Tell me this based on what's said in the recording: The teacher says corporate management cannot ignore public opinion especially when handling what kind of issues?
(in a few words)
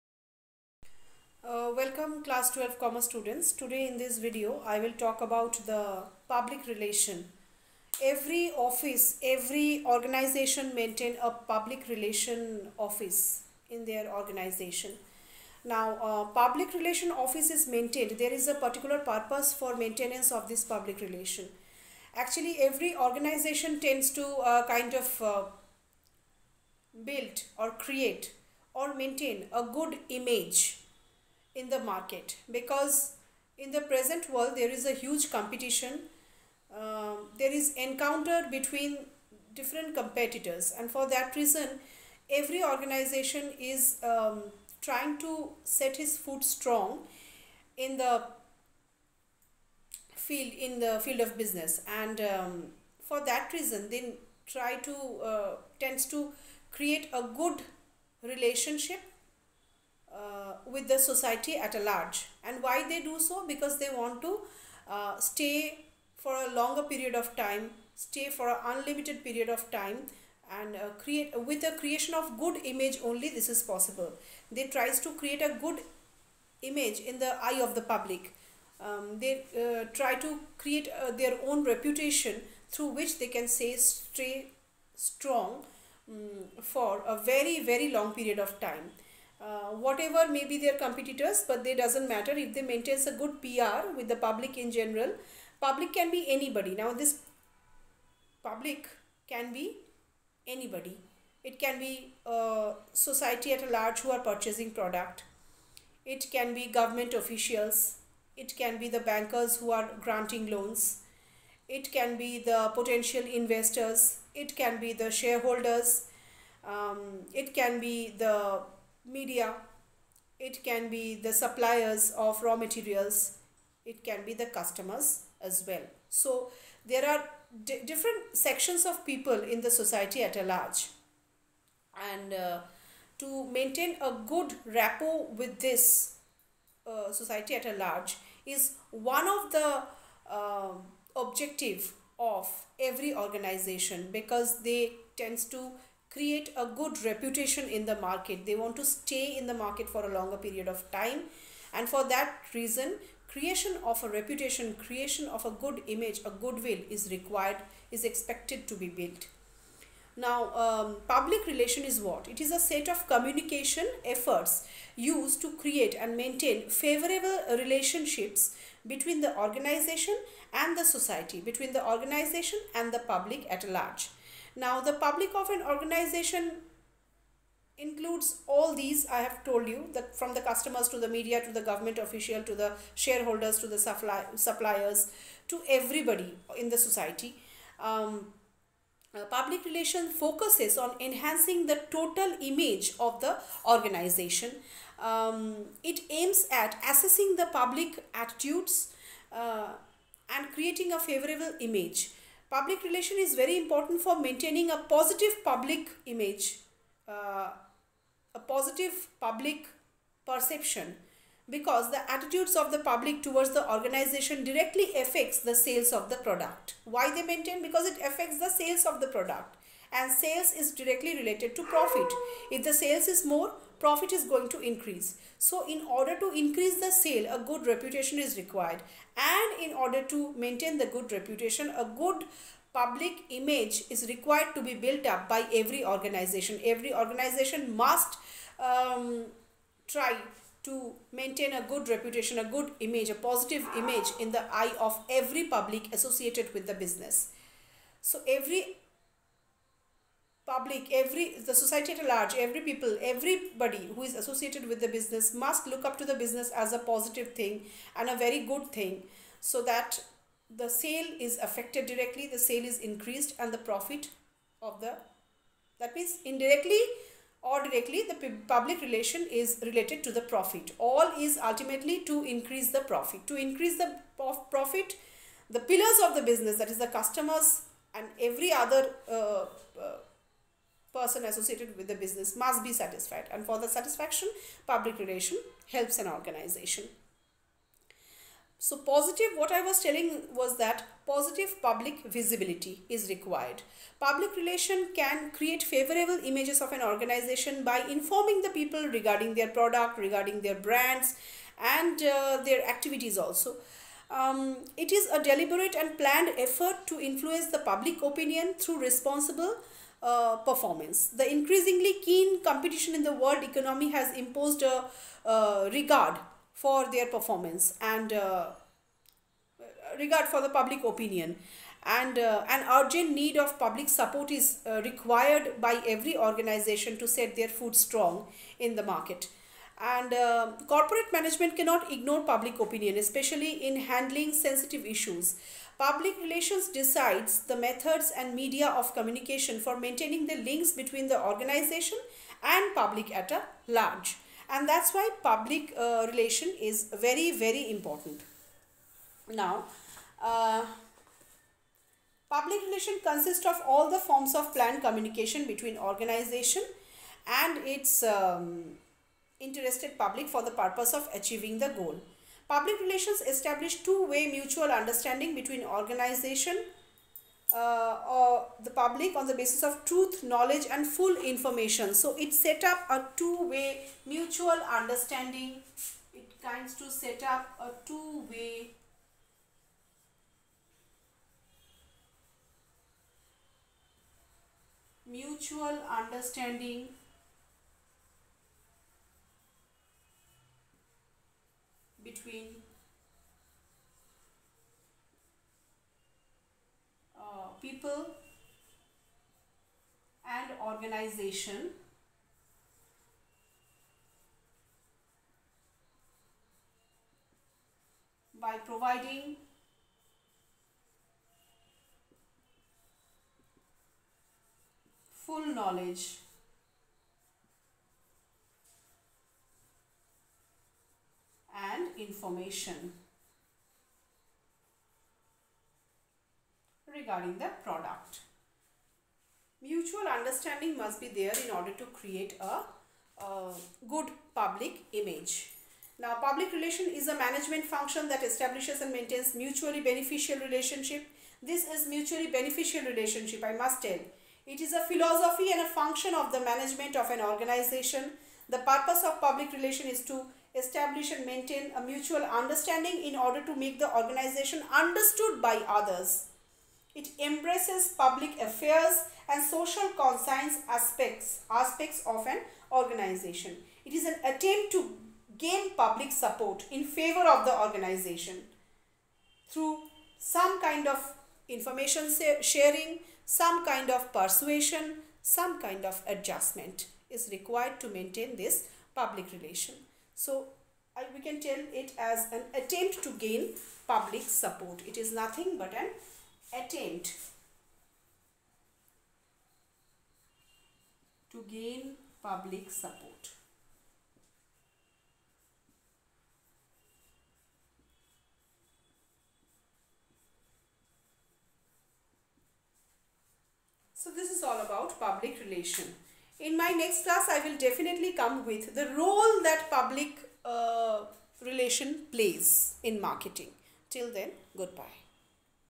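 Sensitive issues.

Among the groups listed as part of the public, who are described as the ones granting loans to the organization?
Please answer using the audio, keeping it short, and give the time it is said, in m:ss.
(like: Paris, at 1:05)
Bankers, at 1:48.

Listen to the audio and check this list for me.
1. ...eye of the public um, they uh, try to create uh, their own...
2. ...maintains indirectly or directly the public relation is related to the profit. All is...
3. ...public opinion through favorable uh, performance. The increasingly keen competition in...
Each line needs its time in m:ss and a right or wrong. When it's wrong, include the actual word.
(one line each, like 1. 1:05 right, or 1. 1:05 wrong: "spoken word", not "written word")
1. 1:17 right
2. 4:25 wrong: "means", not "maintains"
3. 5:07 wrong: "responsible", not "favorable".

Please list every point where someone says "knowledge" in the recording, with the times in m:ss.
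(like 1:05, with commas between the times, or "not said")
6:10, 6:55.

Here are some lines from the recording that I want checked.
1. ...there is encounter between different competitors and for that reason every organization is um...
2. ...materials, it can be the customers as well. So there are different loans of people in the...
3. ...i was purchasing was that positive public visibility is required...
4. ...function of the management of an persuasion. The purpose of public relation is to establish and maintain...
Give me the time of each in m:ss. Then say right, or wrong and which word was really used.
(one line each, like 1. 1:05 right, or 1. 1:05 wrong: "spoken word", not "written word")
1. 0:37 right
2. 2:02 wrong: "sections", not "loans"
3. 4:49 wrong: "telling", not "purchasing"
4. 7:25 wrong: "organization", not "persuasion".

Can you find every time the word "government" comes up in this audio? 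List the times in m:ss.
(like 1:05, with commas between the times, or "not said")
1:46, 3:01.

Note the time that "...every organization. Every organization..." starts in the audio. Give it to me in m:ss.
3:55.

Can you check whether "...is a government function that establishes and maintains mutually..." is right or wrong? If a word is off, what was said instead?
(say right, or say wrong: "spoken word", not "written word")
wrong: "management", not "government".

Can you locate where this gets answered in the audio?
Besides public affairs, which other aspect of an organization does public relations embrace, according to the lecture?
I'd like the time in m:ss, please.
7:39.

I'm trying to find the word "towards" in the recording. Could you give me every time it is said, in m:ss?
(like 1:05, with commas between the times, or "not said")
3:33.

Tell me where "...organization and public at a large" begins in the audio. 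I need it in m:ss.
5:41.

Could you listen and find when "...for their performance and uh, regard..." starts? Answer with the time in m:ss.
5:16.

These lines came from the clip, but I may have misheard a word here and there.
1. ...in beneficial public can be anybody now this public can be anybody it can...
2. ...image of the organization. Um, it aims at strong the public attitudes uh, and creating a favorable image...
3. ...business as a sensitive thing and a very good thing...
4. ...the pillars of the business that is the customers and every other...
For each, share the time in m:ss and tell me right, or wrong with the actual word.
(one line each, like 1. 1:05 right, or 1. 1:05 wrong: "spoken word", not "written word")
1. 1:34 wrong: "general", not "beneficial"
2. 3:12 wrong: "assessing", not "strong"
3. 4:16 wrong: "positive", not "sensitive"
4. 4:35 right.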